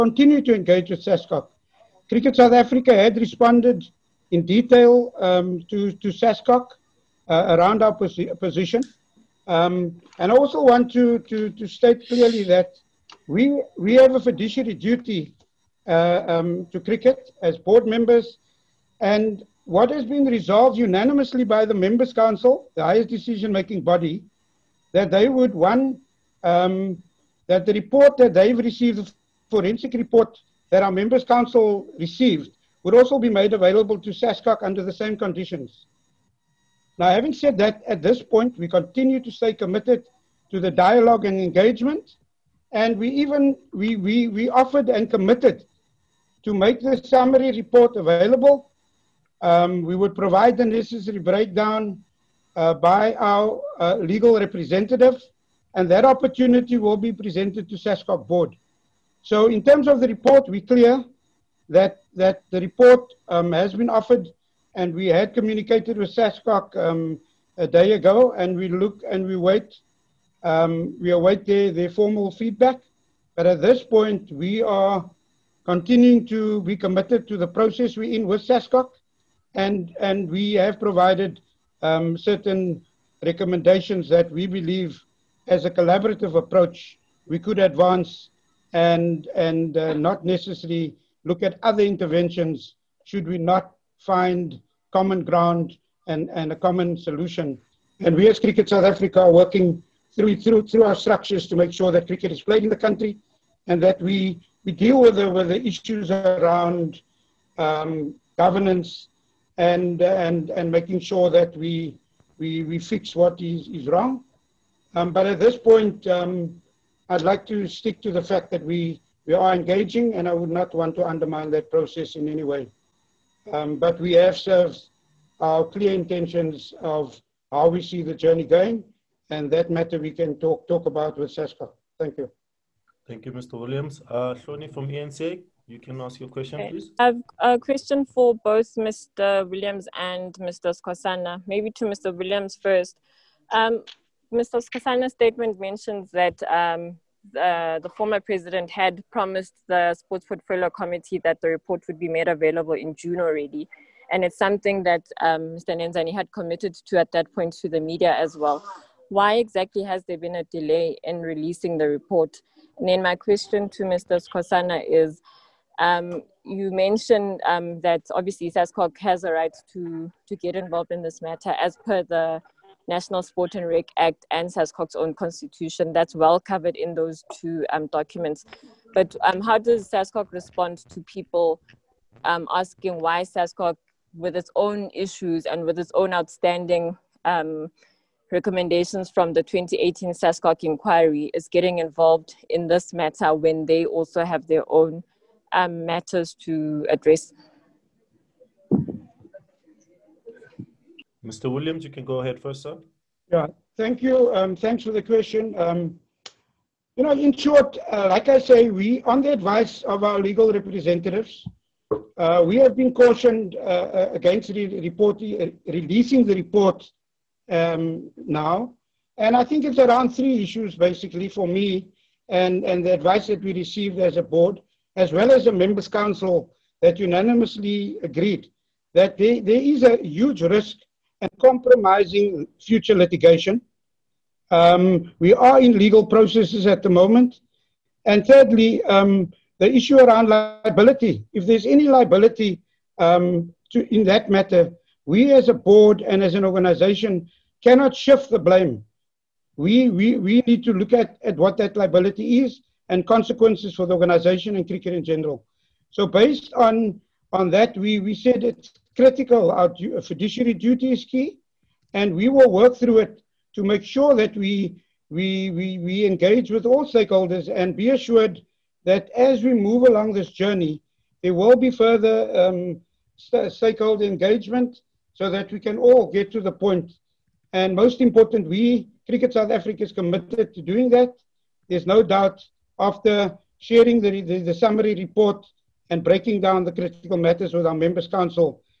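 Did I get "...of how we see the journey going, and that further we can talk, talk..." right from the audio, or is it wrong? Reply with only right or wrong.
wrong.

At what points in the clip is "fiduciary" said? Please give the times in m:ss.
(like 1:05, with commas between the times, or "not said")
0:14, 4:20.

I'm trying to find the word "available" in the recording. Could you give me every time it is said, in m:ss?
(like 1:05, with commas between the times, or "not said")
0:33, 0:47, 2:32.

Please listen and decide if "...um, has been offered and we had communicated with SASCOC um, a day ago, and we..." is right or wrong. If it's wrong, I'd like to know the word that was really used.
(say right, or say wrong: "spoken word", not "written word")
right.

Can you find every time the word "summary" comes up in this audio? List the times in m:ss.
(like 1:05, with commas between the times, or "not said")
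0:46, 4:44.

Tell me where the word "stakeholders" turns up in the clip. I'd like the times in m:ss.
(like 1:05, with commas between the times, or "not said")
4:26, 4:33.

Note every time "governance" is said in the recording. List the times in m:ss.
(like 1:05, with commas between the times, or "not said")
1:48.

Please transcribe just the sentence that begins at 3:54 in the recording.
Um, we are in legal processes at the moment.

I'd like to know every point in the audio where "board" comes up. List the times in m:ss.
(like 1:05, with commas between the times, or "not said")
0:17, 0:58, 3:44, 4:05.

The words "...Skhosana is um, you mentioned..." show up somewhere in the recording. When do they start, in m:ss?
2:44.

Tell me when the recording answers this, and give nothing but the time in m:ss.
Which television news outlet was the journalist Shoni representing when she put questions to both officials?
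2:14.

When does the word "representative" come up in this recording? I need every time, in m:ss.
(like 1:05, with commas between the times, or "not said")
0:54, 3:30.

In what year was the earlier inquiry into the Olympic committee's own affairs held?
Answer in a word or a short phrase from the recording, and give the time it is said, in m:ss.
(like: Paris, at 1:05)
2018, at 3:09.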